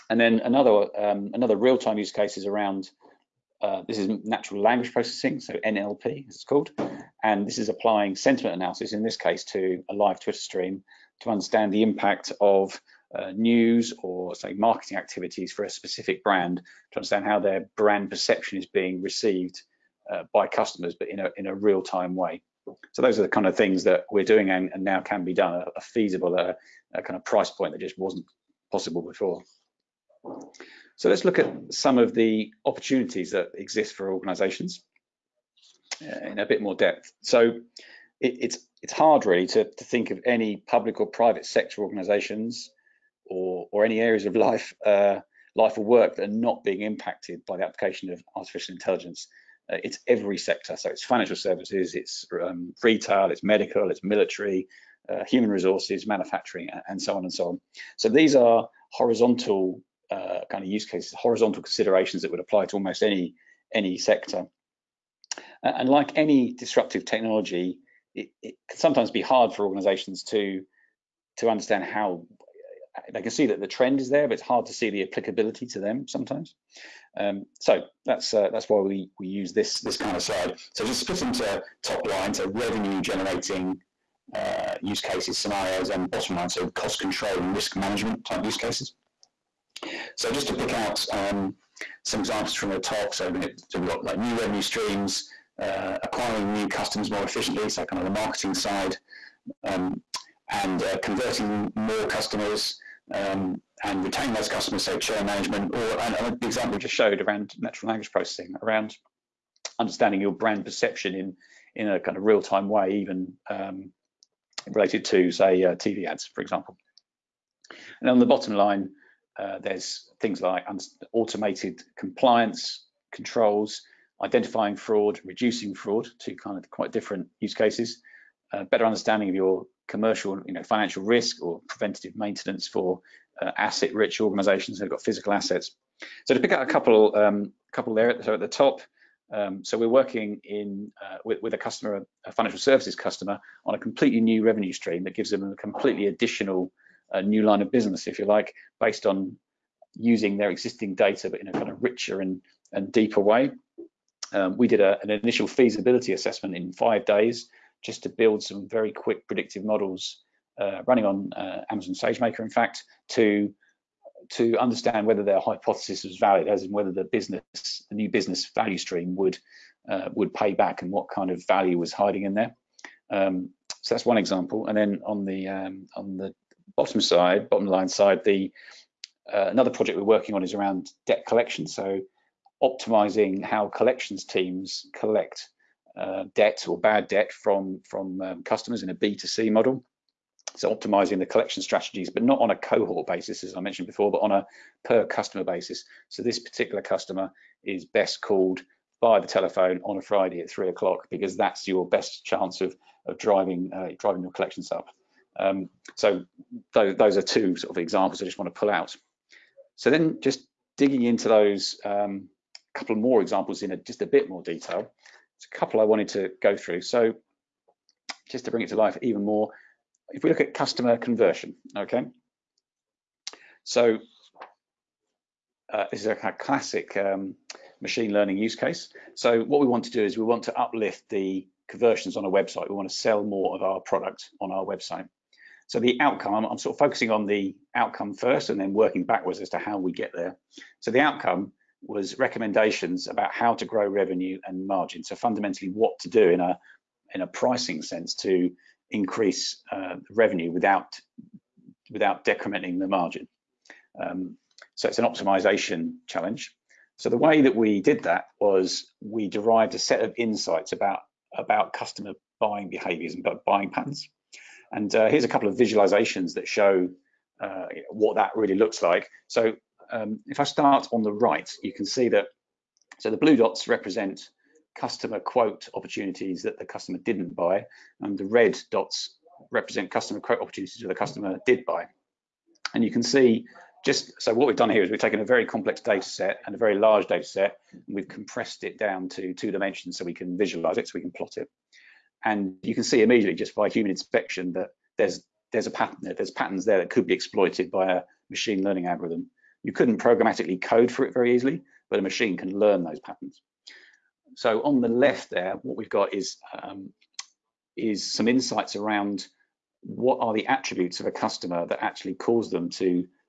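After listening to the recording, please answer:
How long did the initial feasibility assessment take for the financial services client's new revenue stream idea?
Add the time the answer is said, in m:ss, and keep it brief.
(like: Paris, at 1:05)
5 days, at 2:36.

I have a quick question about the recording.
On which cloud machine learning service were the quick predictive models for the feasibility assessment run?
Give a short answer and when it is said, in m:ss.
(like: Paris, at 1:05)
Amazon SageMaker, at 2:41.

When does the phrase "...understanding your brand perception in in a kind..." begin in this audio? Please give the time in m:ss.
1:49.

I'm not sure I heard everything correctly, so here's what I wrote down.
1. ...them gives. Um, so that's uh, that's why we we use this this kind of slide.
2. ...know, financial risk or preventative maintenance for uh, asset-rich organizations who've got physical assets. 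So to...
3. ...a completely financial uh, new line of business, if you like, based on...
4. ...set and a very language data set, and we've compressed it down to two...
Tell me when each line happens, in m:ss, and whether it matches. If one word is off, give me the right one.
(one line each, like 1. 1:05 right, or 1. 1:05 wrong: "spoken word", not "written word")
1. 1:15 wrong: "sometimes", not "gives"
2. 2:10 right
3. 2:25 wrong: "additional", not "financial"
4. 4:46 wrong: "large", not "language".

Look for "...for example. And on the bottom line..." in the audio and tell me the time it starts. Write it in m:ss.
1:56.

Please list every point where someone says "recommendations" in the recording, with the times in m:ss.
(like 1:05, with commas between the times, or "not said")
4:02.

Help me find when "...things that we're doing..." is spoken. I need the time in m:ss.
0:23.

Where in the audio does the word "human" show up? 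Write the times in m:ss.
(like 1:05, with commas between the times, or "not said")
0:55, 4:53.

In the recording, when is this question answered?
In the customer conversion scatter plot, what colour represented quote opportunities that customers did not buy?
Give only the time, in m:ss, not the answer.
4:33.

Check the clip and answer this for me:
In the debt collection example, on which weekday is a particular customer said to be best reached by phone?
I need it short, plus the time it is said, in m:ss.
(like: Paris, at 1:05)
Friday, at 3:20.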